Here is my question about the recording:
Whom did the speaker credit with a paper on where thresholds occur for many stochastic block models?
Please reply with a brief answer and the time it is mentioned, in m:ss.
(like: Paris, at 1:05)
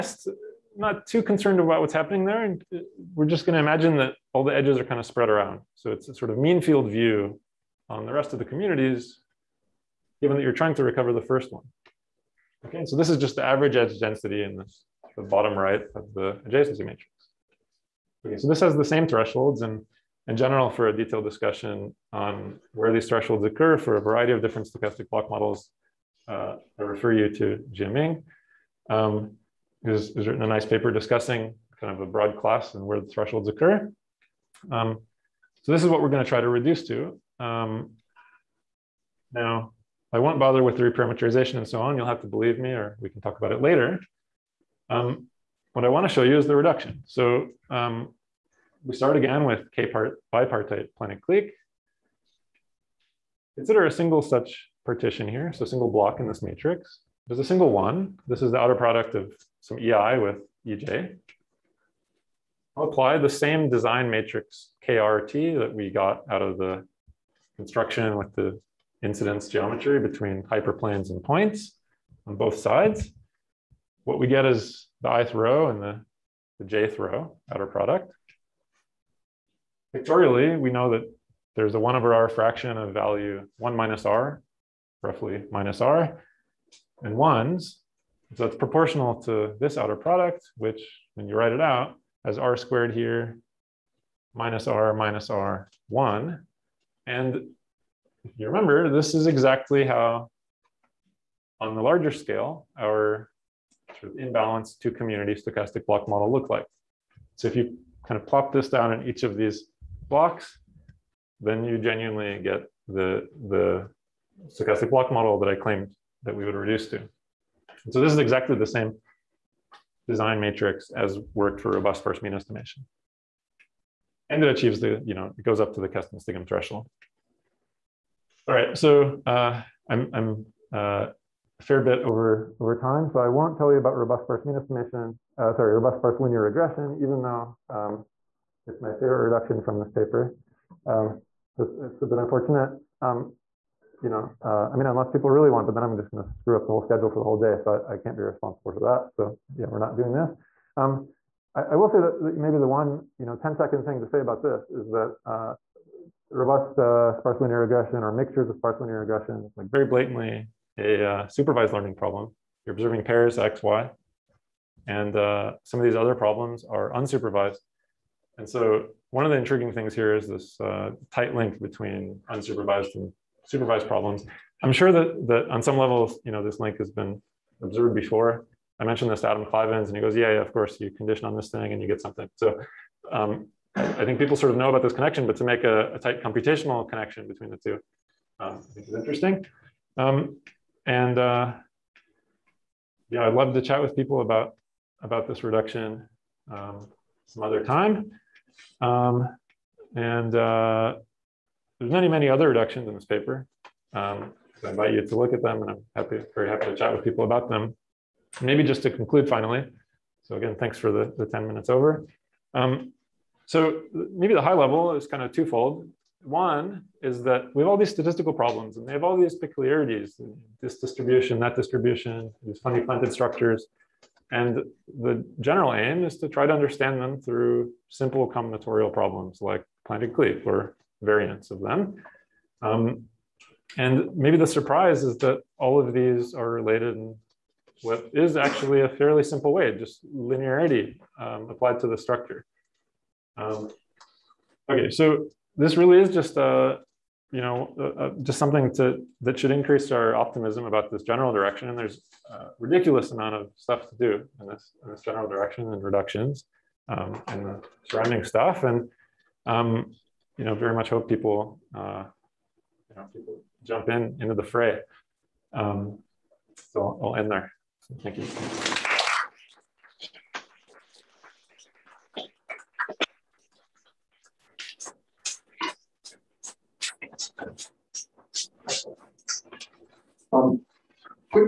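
Jiaming, at 0:27.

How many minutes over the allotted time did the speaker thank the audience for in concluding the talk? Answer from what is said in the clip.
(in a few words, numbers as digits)
10.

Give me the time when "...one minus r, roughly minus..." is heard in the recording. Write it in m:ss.
1:23.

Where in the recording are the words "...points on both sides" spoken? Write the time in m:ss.
1:11.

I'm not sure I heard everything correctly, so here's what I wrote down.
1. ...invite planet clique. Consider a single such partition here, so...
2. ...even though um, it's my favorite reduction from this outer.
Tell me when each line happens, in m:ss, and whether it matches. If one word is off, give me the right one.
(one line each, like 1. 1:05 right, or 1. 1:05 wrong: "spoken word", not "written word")
1. 0:50 wrong: "bipartite", not "invite"
2. 2:16 wrong: "paper", not "outer".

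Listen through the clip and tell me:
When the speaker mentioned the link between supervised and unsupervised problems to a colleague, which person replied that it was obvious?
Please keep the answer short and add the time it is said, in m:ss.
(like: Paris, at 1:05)
Adam Klivans, at 2:59.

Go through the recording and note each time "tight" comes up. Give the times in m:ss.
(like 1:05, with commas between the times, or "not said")
2:51, 3:05.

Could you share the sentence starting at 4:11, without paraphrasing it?
And there's a ridiculous amount of stuff to do in this, in this general direction and reductions um, and surrounding stuff.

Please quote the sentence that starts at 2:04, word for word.
And it achieves the, you know, it goes up to the Kesten-Stigum threshold.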